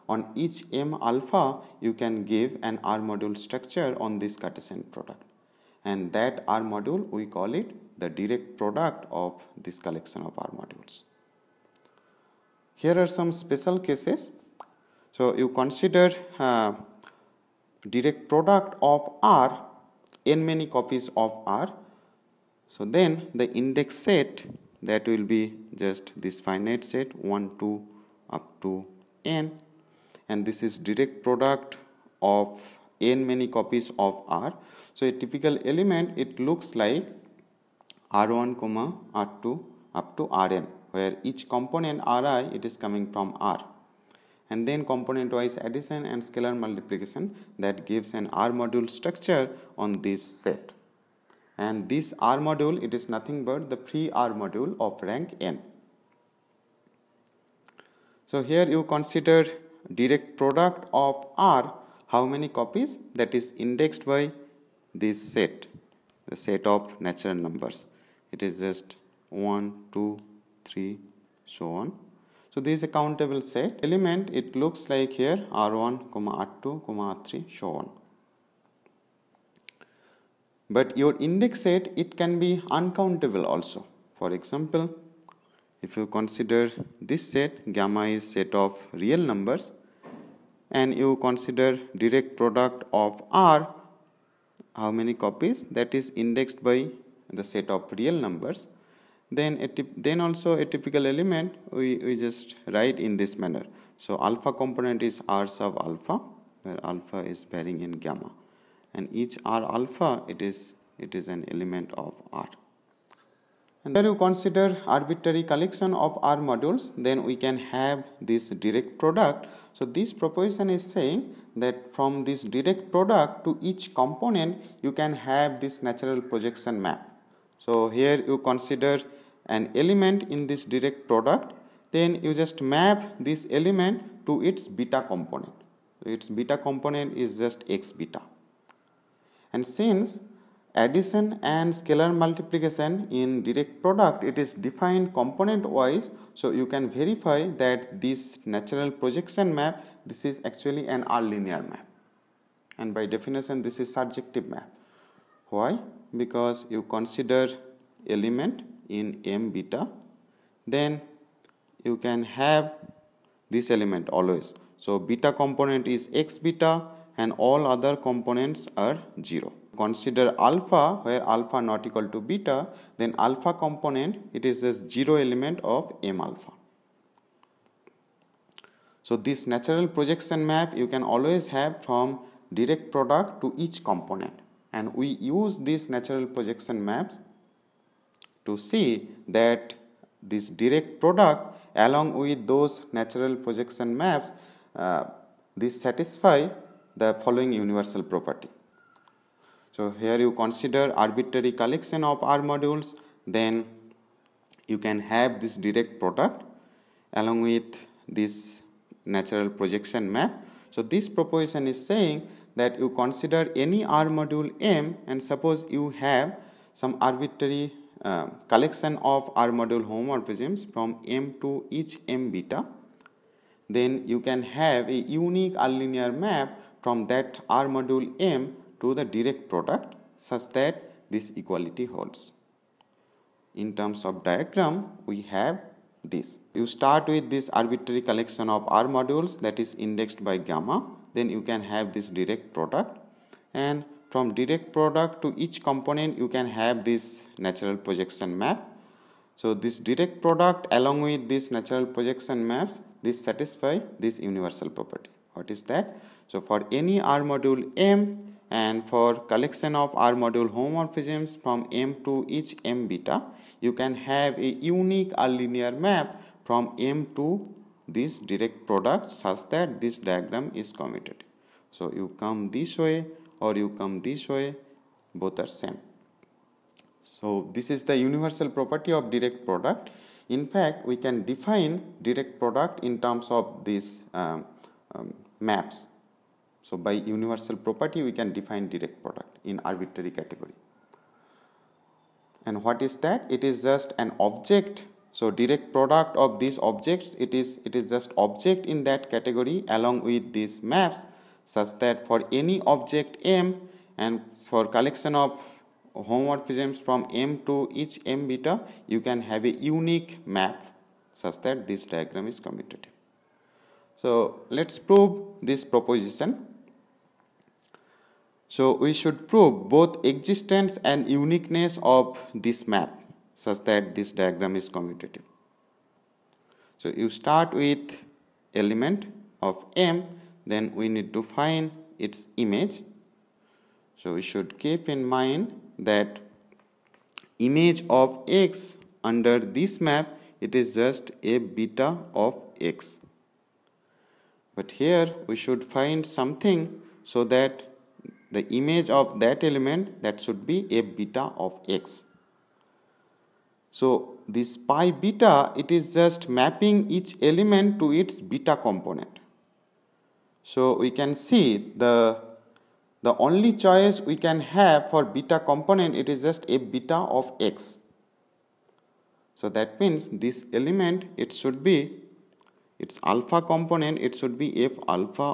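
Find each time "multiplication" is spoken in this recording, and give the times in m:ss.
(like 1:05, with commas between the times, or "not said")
0:46, 2:22.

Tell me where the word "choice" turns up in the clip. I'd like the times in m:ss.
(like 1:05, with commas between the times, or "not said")
6:03.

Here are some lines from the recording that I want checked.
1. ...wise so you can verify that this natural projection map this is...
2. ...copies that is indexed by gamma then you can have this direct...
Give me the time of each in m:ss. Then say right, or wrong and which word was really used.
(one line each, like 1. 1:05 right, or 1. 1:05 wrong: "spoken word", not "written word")
1. 2:25 right
2. 3:58 wrong: "modules", not "copies".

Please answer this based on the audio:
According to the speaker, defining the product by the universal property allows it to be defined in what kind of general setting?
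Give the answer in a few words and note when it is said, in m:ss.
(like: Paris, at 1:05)
arbitrary category, at 4:49.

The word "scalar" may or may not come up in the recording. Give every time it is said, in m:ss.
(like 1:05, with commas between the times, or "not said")
0:46, 2:21.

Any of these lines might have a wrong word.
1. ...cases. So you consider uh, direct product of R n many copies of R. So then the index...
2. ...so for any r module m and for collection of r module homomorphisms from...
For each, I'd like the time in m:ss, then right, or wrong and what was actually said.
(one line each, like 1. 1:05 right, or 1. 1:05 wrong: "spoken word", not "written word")
1. 0:13 right
2. 4:16 right.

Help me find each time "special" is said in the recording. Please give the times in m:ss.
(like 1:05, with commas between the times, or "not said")
0:13.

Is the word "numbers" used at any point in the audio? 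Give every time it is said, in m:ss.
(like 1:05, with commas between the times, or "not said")
1:07, 1:29, 1:38.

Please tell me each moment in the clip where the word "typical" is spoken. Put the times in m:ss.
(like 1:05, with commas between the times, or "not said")
0:35, 1:40.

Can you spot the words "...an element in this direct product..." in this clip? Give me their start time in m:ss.
2:09.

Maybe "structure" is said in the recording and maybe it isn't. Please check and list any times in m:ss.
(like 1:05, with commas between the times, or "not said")
0:03, 0:48.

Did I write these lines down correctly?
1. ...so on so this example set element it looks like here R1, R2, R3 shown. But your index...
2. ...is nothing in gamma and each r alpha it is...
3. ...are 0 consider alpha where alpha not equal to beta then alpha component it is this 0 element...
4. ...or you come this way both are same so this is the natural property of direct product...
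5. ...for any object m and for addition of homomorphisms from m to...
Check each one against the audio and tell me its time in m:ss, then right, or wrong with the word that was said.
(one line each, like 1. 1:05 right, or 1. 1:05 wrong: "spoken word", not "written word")
1. 1:11 wrong: "countable", not "example"
2. 1:47 wrong: "varying", not "nothing"
3. 2:48 right
4. 4:33 wrong: "universal", not "natural"
5. 5:02 wrong: "collection", not "addition".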